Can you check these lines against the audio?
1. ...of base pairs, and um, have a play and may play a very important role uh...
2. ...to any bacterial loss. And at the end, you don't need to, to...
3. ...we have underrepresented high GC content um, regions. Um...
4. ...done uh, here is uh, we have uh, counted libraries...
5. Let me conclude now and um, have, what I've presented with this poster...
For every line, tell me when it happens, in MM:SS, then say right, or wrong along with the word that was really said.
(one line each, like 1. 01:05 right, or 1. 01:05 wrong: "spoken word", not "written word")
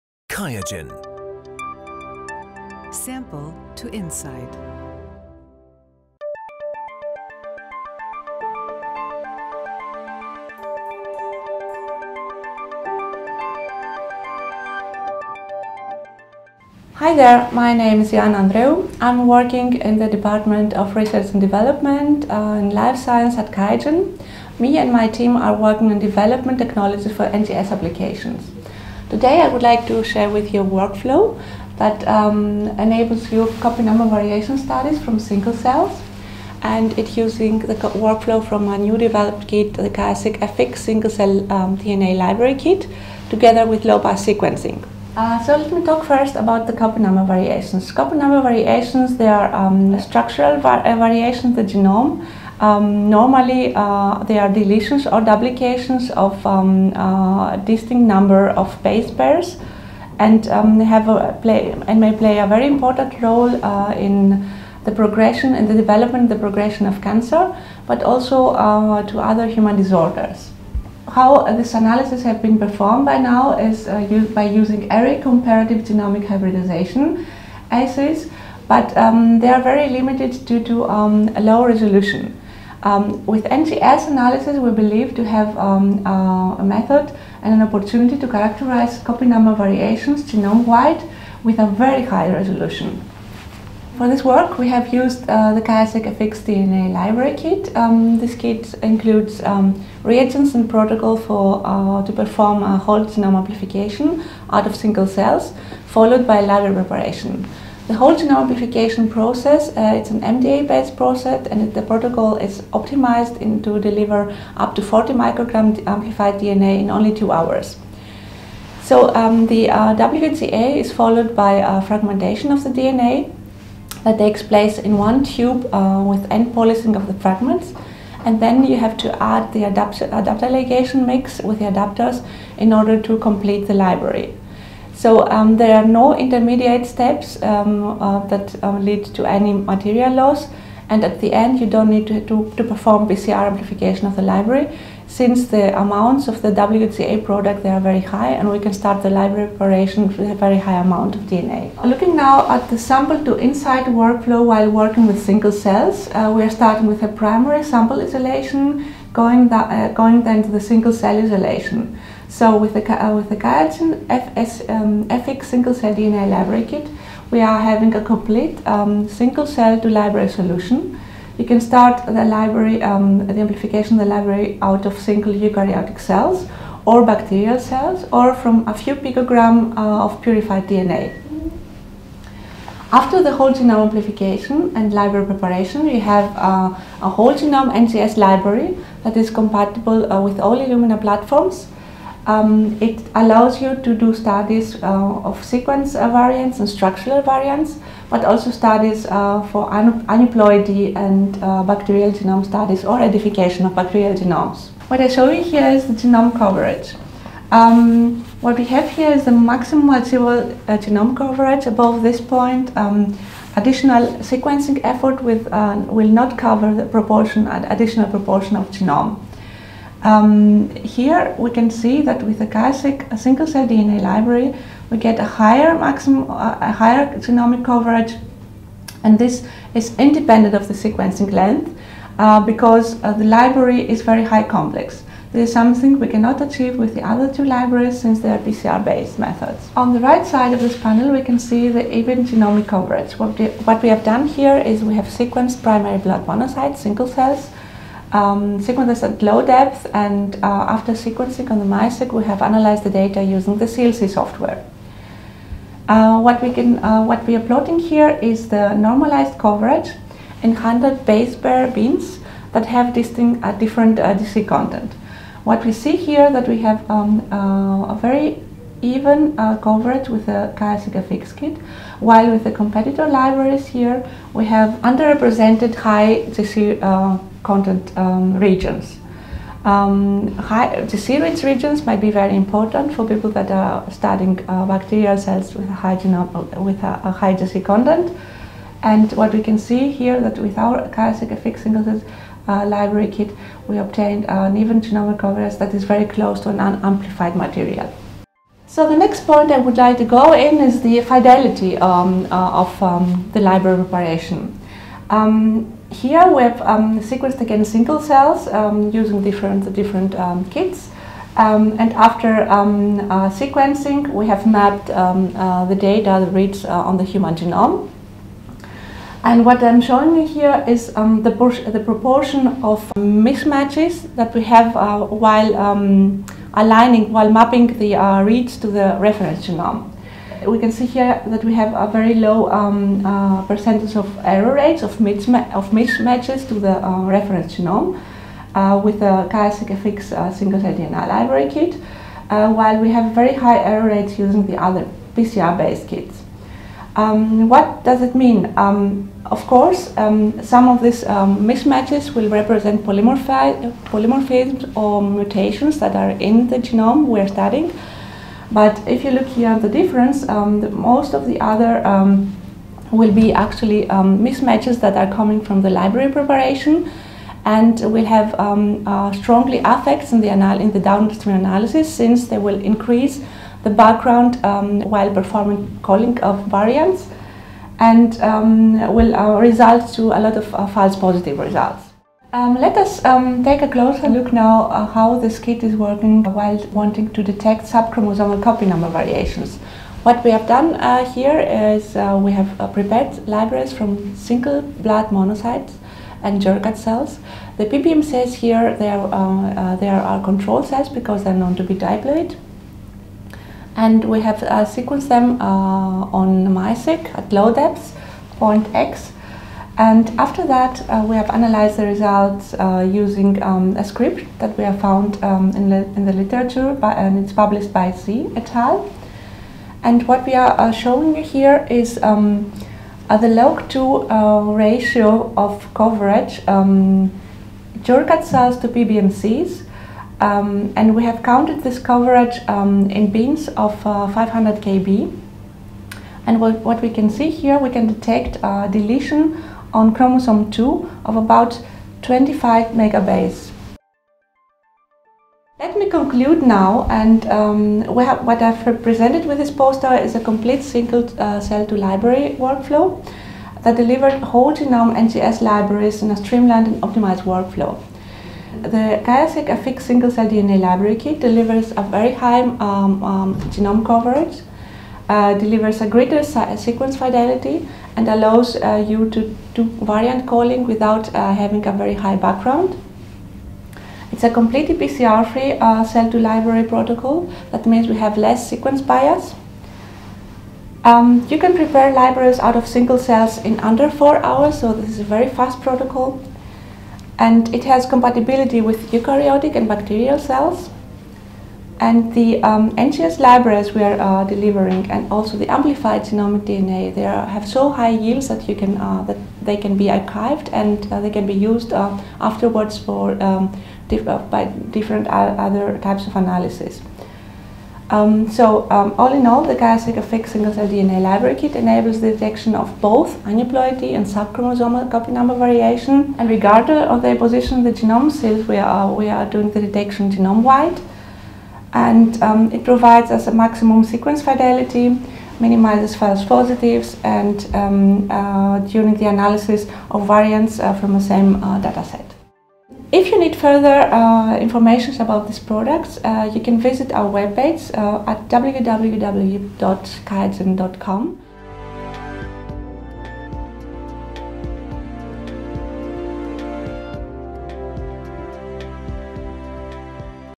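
1. 00:58 right
2. 02:19 wrong: "material", not "bacterial"
3. 04:34 right
4. 06:30 wrong: "prepared", not "counted"
5. 07:25 right.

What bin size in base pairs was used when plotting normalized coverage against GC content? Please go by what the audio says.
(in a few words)
100 base pair.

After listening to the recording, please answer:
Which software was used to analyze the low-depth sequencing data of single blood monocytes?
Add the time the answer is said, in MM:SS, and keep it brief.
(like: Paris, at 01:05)
CLC, at 04:13.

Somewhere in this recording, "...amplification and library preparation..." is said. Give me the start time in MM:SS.
03:03.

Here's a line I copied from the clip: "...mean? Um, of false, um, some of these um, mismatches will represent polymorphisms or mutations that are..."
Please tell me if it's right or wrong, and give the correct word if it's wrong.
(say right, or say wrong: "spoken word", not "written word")
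wrong: "course", not "false".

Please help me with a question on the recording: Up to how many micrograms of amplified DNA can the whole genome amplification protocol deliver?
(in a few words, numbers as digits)
40.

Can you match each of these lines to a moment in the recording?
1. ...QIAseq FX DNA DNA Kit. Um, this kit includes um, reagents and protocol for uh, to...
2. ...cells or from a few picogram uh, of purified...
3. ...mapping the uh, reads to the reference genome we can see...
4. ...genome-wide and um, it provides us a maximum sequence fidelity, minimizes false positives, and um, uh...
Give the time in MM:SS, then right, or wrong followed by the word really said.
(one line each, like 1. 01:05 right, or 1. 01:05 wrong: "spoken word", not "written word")
1. 01:35 wrong: "Library", not "DNA"
2. 02:57 right
3. 05:27 right
4. 08:40 right.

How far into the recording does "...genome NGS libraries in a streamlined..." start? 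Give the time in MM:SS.
07:34.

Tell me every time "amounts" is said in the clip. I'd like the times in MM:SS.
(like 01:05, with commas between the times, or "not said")
02:25, 02:30.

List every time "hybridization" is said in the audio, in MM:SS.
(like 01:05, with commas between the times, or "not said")
01:16.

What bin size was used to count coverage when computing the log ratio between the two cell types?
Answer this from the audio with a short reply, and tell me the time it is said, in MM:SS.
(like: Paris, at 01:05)
500 kb, at 07:14.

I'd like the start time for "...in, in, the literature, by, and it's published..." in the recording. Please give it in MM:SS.
06:55.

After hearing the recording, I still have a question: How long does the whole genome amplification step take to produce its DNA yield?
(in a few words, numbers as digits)
2 hours.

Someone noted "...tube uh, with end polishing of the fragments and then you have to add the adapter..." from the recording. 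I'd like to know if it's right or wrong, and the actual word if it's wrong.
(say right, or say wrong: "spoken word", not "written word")
right.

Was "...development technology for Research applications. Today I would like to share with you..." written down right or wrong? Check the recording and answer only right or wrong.
wrong.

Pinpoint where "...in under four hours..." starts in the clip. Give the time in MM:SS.
08:03.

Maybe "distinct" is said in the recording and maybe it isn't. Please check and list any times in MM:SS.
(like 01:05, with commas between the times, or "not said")
00:57, 04:22.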